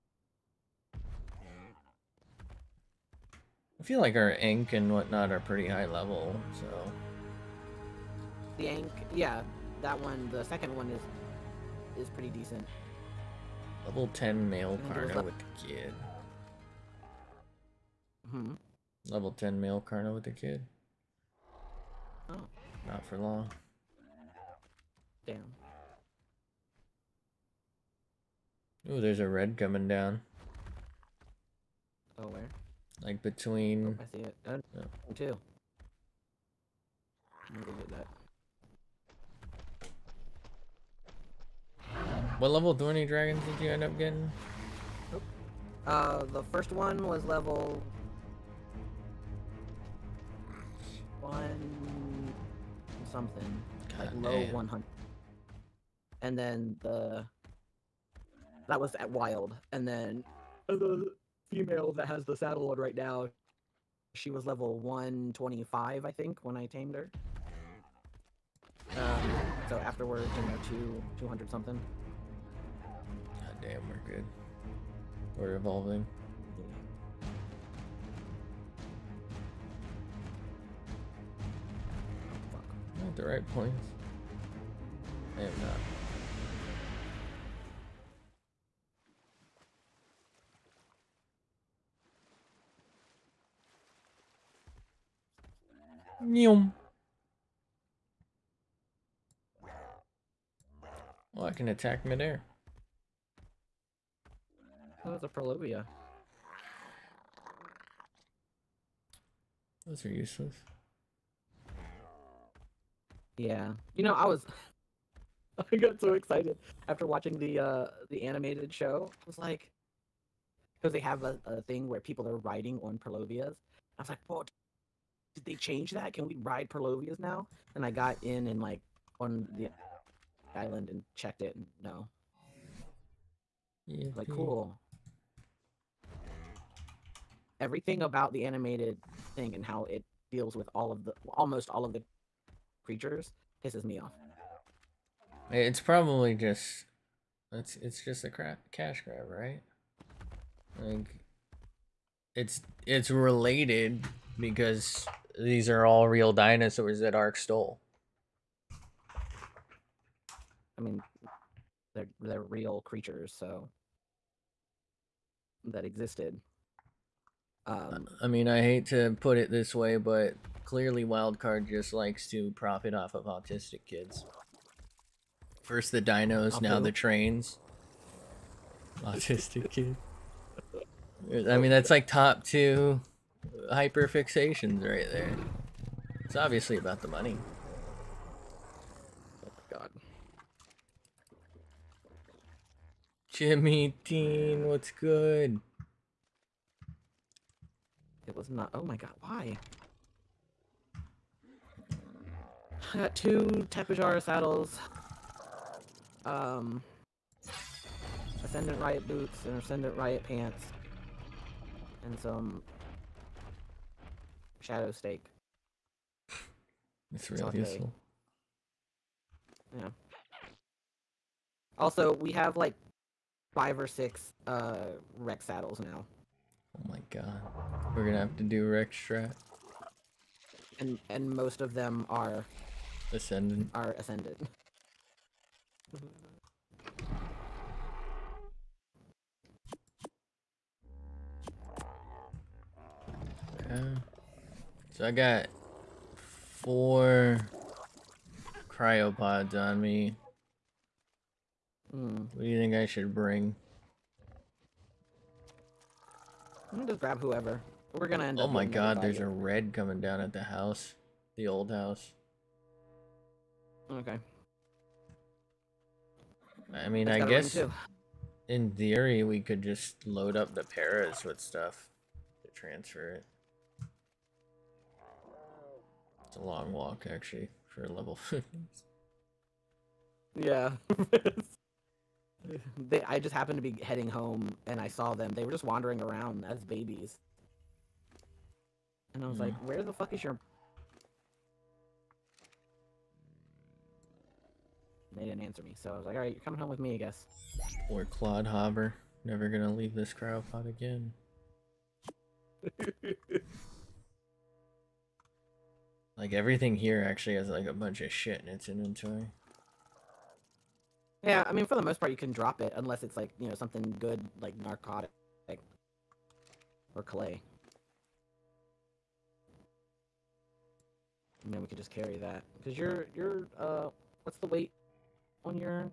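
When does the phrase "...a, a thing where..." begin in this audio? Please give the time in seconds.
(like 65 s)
121 s.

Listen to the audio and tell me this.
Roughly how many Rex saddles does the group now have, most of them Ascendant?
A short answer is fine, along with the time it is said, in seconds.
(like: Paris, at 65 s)
5 or 6, at 223 s.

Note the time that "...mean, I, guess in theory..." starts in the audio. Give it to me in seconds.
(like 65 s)
266 s.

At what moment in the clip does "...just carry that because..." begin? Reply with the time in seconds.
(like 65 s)
321 s.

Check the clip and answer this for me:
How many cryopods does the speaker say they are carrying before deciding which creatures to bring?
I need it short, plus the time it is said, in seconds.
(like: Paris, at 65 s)
4, at 246 s.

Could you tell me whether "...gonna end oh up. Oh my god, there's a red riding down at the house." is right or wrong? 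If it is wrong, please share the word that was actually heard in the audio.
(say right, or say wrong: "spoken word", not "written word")
wrong: "coming", not "riding".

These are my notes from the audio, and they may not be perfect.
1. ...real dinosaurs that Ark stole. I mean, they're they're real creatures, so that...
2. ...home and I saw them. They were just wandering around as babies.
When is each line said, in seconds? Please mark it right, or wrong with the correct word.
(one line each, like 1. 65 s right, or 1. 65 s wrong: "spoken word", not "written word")
1. 156 s right
2. 284 s right.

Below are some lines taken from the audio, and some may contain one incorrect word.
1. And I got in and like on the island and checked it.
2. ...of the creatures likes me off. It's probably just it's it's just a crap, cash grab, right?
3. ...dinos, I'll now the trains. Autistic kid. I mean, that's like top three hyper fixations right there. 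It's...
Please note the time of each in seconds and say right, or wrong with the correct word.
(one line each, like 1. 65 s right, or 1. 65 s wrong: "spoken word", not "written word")
1. 127 s right
2. 141 s wrong: "pisses", not "likes"
3. 175 s wrong: "two", not "three".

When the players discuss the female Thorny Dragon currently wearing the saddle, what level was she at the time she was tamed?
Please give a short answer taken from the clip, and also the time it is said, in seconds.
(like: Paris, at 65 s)
125, at 64 s.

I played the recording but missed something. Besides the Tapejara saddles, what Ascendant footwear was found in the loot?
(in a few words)
Riot boots.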